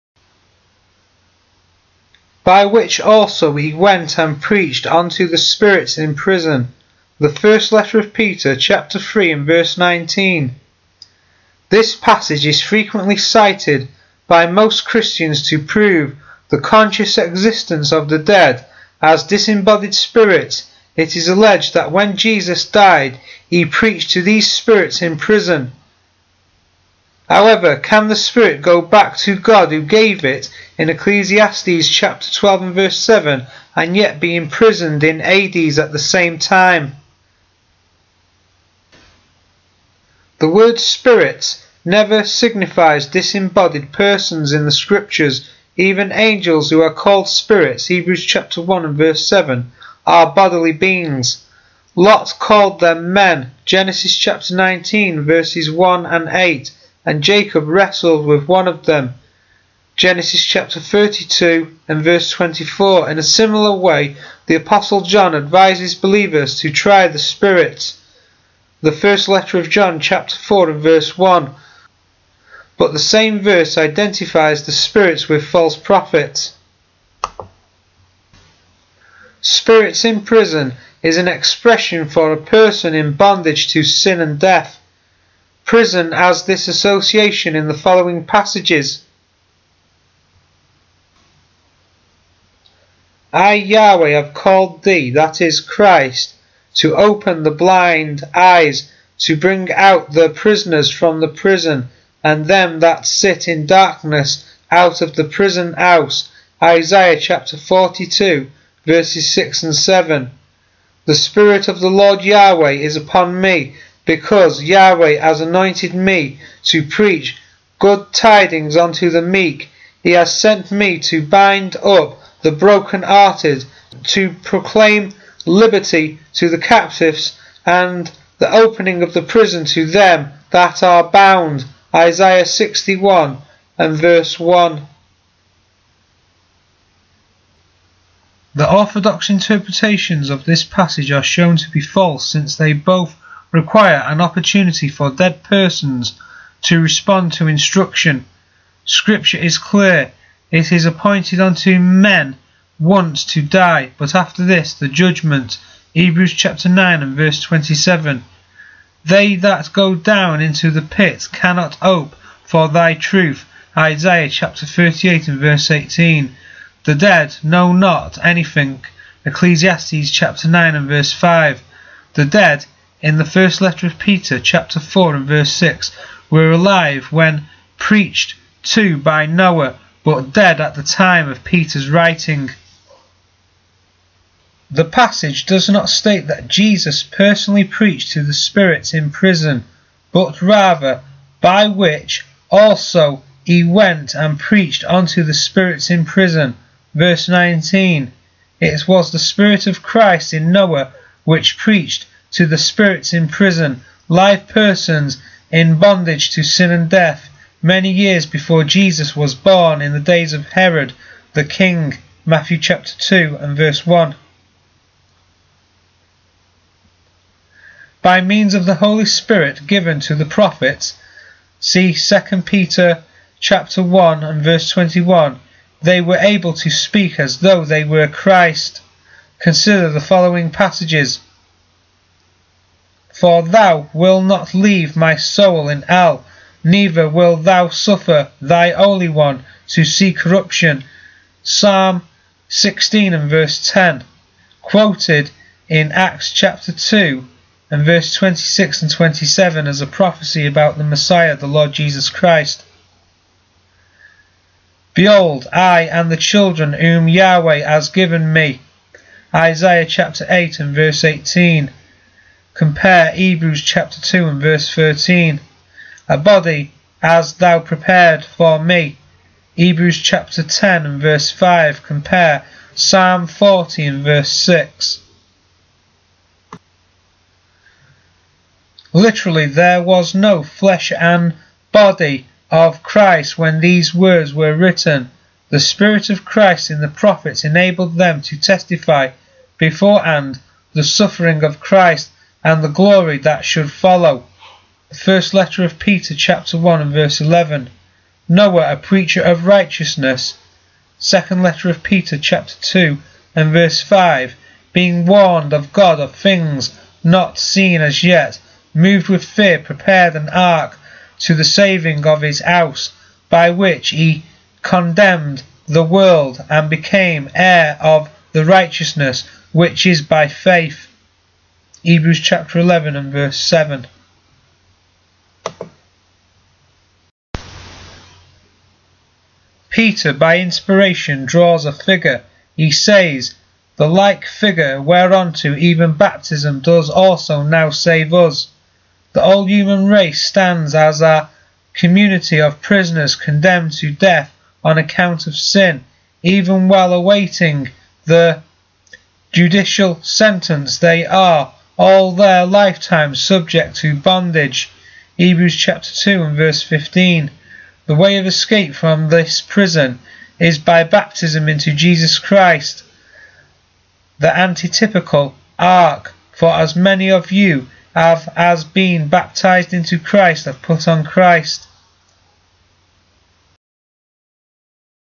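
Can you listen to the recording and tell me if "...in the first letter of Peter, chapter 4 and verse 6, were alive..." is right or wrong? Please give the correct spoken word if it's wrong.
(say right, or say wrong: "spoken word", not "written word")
right.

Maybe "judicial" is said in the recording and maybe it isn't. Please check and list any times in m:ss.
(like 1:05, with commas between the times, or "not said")
5:49.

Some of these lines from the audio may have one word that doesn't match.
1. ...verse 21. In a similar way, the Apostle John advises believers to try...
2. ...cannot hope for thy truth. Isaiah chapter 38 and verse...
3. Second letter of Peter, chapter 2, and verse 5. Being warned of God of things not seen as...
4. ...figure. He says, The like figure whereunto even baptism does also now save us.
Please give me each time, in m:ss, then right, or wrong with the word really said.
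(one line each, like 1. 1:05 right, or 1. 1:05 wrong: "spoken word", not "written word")
1. 1:02 wrong: "24", not "21"
2. 2:41 right
3. 5:00 right
4. 5:31 right.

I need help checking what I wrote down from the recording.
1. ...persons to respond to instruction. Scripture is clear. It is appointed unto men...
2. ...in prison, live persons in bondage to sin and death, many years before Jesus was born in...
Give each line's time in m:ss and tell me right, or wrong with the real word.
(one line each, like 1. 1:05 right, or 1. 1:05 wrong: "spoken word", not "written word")
1. 2:25 right
2. 3:23 right.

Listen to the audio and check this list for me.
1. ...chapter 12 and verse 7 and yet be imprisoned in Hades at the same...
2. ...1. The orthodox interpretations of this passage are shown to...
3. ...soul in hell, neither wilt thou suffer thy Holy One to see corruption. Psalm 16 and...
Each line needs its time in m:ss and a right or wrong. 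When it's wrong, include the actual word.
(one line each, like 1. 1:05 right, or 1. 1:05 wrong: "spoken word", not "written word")
1. 0:31 right
2. 2:14 right
3. 3:55 right.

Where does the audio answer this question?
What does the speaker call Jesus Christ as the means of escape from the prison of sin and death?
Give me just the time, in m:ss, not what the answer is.
6:04.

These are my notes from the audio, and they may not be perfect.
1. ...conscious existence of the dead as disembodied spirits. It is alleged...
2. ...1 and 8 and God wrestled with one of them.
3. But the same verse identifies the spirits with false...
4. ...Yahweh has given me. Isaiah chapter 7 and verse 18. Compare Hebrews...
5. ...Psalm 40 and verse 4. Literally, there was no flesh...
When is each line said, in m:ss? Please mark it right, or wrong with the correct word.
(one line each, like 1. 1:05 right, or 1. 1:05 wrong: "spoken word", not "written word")
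1. 0:16 right
2. 0:55 wrong: "Jacob", not "God"
3. 1:12 right
4. 4:17 wrong: "8", not "7"
5. 4:32 wrong: "6", not "4".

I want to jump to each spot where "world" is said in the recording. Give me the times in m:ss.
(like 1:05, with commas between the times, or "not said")
5:15.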